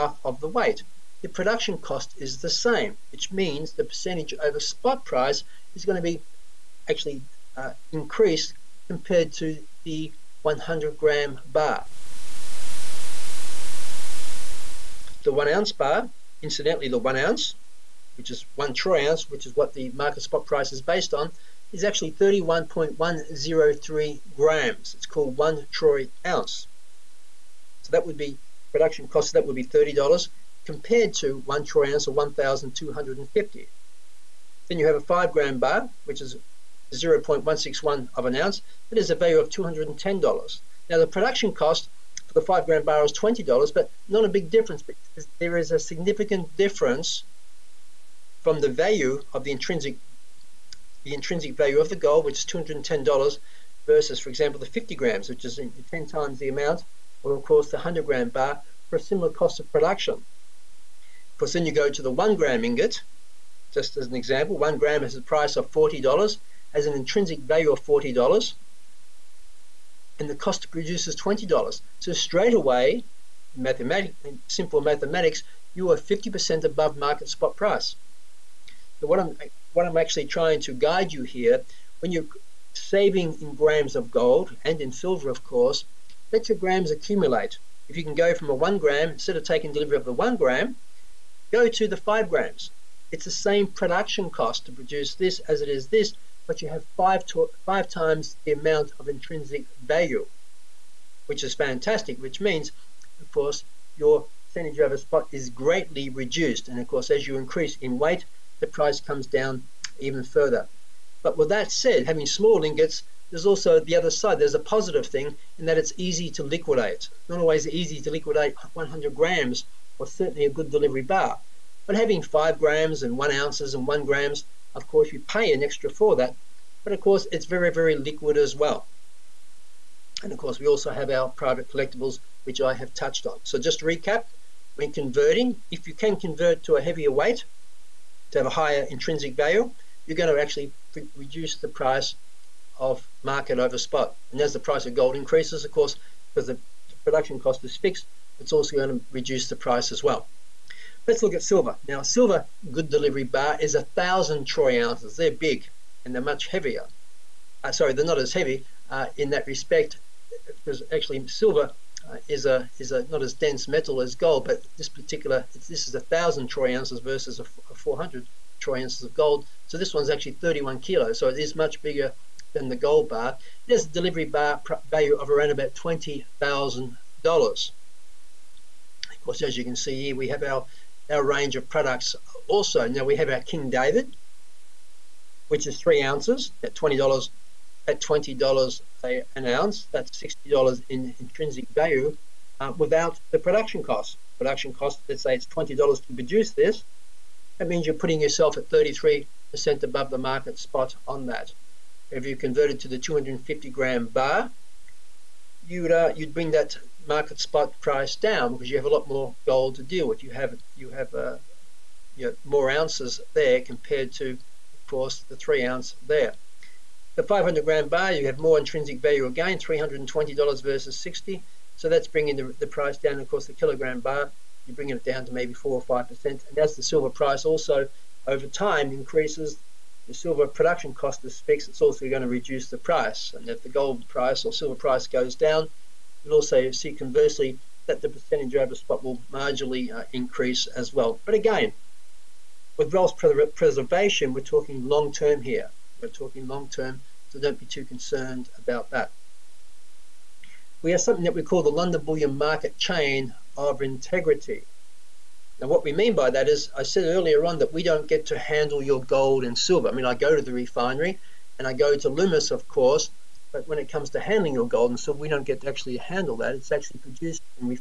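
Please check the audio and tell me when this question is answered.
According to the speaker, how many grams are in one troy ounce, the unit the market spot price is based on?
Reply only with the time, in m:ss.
0:22.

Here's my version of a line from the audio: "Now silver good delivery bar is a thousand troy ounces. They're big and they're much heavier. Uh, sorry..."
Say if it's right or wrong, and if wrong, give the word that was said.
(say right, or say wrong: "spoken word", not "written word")
right.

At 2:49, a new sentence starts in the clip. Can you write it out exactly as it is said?
So this one's actually 31 kilos, so it is much bigger than the gold bar.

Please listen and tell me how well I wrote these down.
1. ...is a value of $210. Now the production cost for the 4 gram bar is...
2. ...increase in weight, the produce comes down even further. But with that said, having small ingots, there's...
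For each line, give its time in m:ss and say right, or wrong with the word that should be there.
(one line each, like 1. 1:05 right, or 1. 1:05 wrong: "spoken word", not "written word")
1. 0:38 wrong: "5", not "4"
2. 1:47 wrong: "price", not "produce".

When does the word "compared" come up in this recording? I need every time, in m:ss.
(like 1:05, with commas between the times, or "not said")
0:08, 0:30, 3:33.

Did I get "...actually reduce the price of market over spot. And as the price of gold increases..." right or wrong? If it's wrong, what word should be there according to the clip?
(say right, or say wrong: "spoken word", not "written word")
right.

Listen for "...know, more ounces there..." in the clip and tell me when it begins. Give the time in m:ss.
3:32.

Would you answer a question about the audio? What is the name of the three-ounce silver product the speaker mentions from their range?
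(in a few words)
King David.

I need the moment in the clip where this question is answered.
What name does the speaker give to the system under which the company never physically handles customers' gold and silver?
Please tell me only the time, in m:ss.
4:11.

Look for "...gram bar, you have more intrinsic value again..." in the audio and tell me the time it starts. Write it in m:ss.
3:37.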